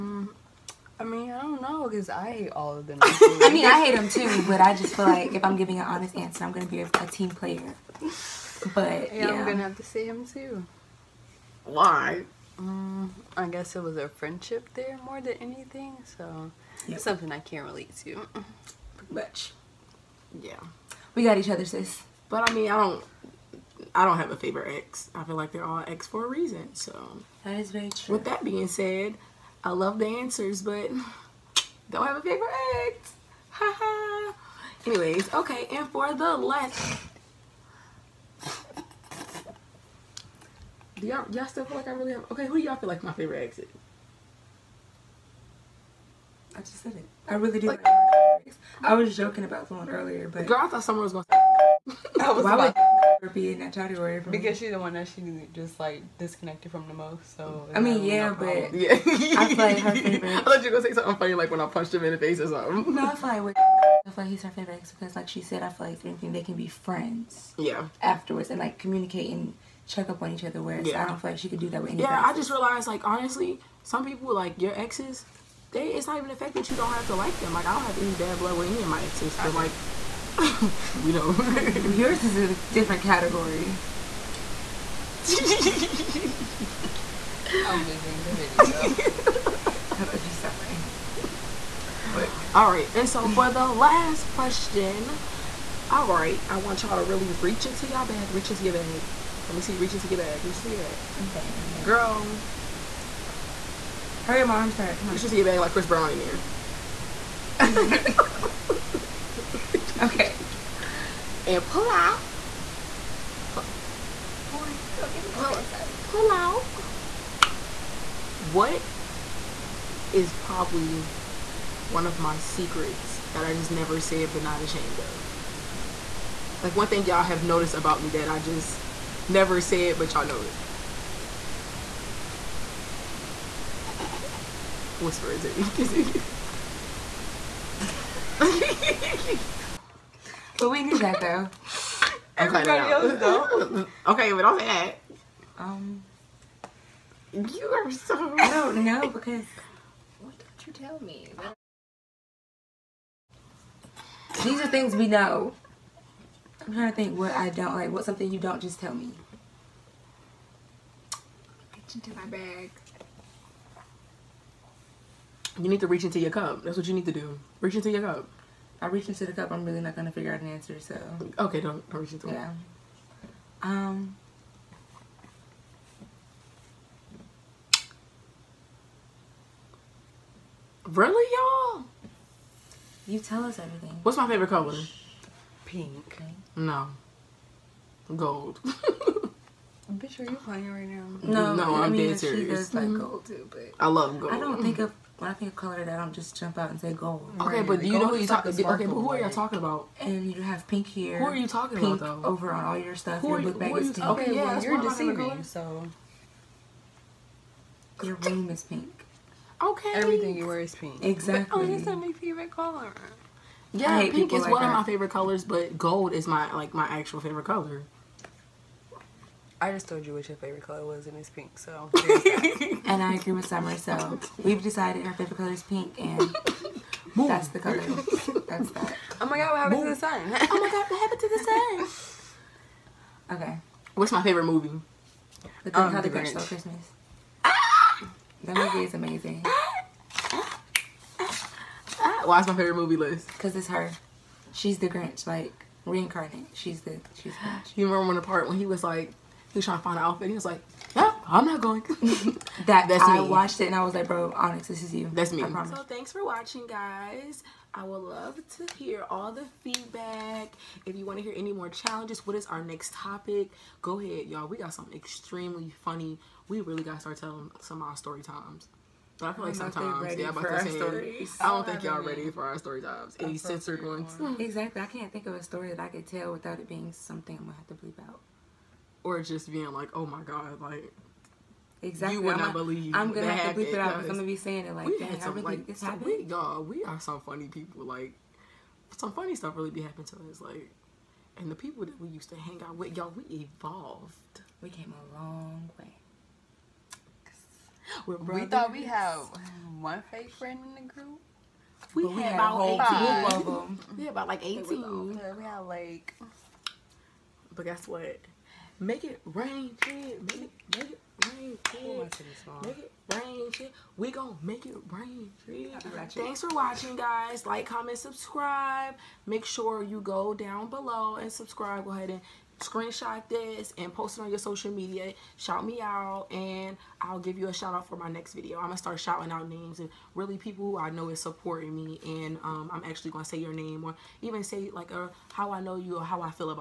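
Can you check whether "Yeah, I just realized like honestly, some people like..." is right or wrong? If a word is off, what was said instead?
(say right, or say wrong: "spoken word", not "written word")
right.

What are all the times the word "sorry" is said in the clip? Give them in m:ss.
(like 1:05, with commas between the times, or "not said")
1:55.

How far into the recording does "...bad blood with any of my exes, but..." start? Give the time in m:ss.
1:18.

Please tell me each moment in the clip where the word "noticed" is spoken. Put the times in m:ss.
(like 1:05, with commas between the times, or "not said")
2:07.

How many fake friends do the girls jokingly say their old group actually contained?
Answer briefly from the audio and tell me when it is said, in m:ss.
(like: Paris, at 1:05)
18, at 5:04.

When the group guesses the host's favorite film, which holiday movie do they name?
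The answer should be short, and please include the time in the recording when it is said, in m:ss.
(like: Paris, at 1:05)
How the Grinch Stole Christmas, at 3:55.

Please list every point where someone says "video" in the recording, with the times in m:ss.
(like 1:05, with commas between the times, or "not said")
1:28, 5:28.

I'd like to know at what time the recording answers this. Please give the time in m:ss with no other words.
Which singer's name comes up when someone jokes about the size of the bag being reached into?
1:45.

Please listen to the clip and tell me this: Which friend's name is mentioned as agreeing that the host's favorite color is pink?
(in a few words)
Summer.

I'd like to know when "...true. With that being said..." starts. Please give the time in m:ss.
0:27.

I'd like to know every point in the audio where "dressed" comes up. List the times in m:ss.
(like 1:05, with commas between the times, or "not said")
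not said.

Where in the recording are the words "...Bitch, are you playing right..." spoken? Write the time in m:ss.
3:08.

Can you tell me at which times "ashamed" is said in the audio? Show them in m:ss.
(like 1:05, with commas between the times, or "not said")
2:04.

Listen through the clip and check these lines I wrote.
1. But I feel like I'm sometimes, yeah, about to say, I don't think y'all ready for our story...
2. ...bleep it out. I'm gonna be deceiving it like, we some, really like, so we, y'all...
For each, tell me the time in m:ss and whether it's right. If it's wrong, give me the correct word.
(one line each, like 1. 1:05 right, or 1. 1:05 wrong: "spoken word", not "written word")
1. 4:29 right
2. 4:43 wrong: "saying", not "deceiving".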